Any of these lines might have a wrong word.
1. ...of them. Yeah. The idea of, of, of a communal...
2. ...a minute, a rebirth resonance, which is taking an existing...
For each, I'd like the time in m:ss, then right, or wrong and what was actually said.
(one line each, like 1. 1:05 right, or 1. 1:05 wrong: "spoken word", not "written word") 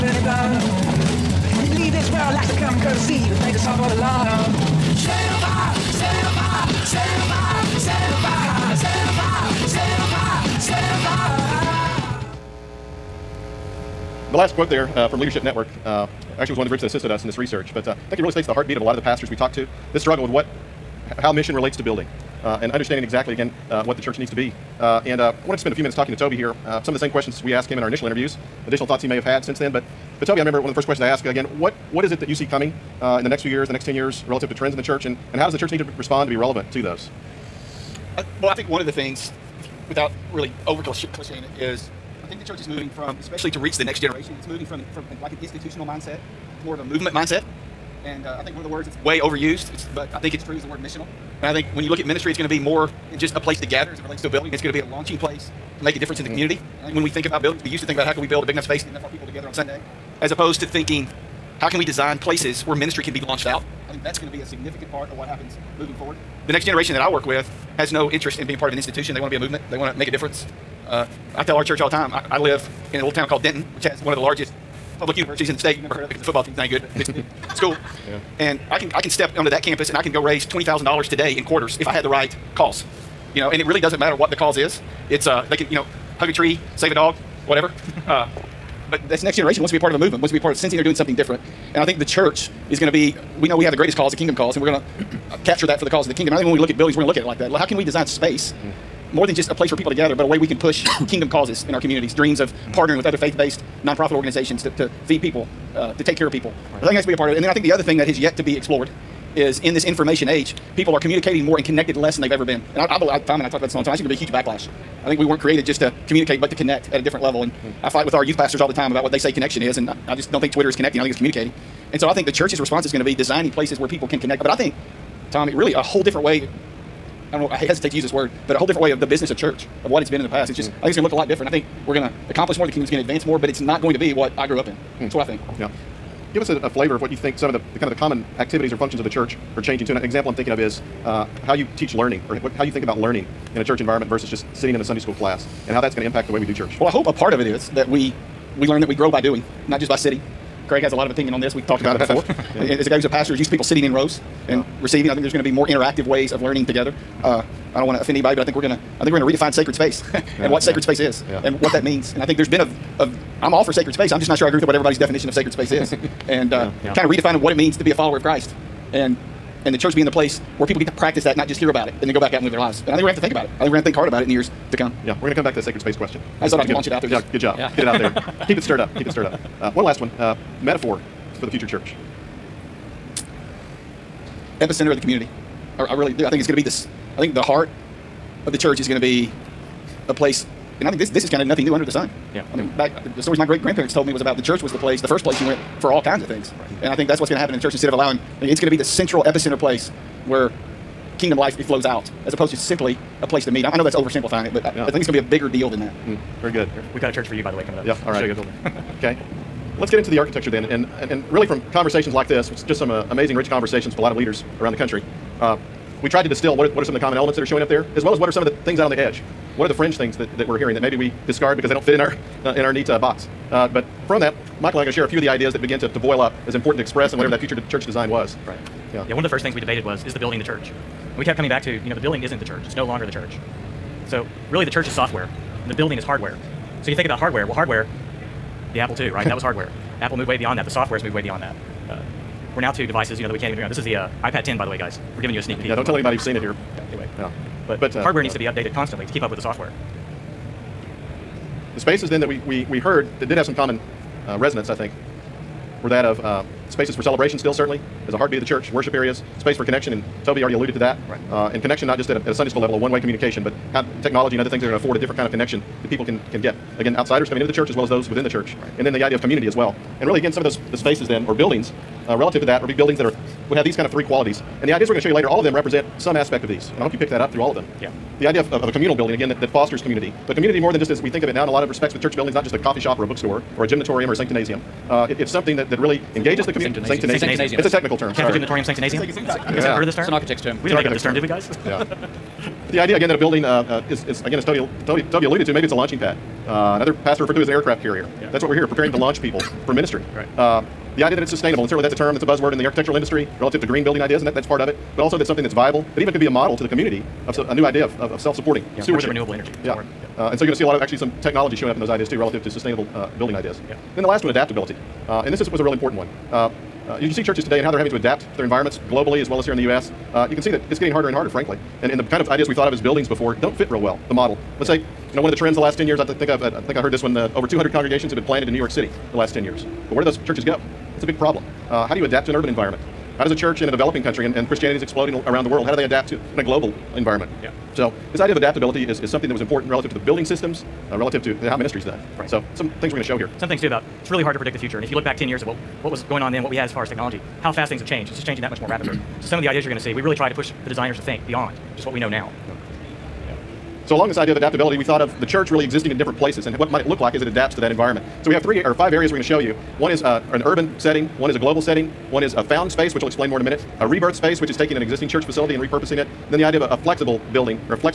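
1. 4:37 right
2. 6:03 wrong: "space", not "resonance".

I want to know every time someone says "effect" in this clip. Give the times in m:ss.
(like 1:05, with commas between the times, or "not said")
not said.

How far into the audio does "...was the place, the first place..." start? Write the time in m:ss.
3:14.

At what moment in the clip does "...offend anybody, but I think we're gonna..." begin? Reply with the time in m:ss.
2:37.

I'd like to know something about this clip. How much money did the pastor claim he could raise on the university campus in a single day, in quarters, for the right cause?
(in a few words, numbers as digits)
$20,000.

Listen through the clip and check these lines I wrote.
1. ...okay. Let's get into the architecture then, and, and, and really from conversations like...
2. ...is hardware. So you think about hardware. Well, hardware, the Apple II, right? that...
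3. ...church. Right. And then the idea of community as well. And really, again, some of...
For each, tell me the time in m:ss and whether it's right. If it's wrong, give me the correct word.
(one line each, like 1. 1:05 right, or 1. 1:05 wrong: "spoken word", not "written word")
1. 3:28 right
2. 3:55 right
3. 4:28 right.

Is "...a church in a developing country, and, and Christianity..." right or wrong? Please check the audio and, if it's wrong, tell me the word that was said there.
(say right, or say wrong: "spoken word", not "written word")
right.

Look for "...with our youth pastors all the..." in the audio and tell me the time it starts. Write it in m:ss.
1:58.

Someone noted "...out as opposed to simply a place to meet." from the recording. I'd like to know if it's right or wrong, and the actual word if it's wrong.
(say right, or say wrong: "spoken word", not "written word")
right.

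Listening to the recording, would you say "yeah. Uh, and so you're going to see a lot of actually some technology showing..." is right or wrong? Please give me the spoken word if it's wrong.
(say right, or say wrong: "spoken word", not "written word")
right.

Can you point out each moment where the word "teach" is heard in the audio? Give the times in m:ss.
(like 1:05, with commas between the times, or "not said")
2:21.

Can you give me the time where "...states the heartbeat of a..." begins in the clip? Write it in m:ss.
0:18.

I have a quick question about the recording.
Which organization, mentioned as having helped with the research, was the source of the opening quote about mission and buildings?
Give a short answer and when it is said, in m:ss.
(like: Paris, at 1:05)
Leadership Network, at 0:15.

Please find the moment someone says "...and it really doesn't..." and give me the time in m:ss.
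1:23.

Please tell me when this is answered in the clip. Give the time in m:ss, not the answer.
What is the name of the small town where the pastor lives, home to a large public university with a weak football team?
1:13.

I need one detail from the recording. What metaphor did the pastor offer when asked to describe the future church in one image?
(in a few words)
Epicenter of the community.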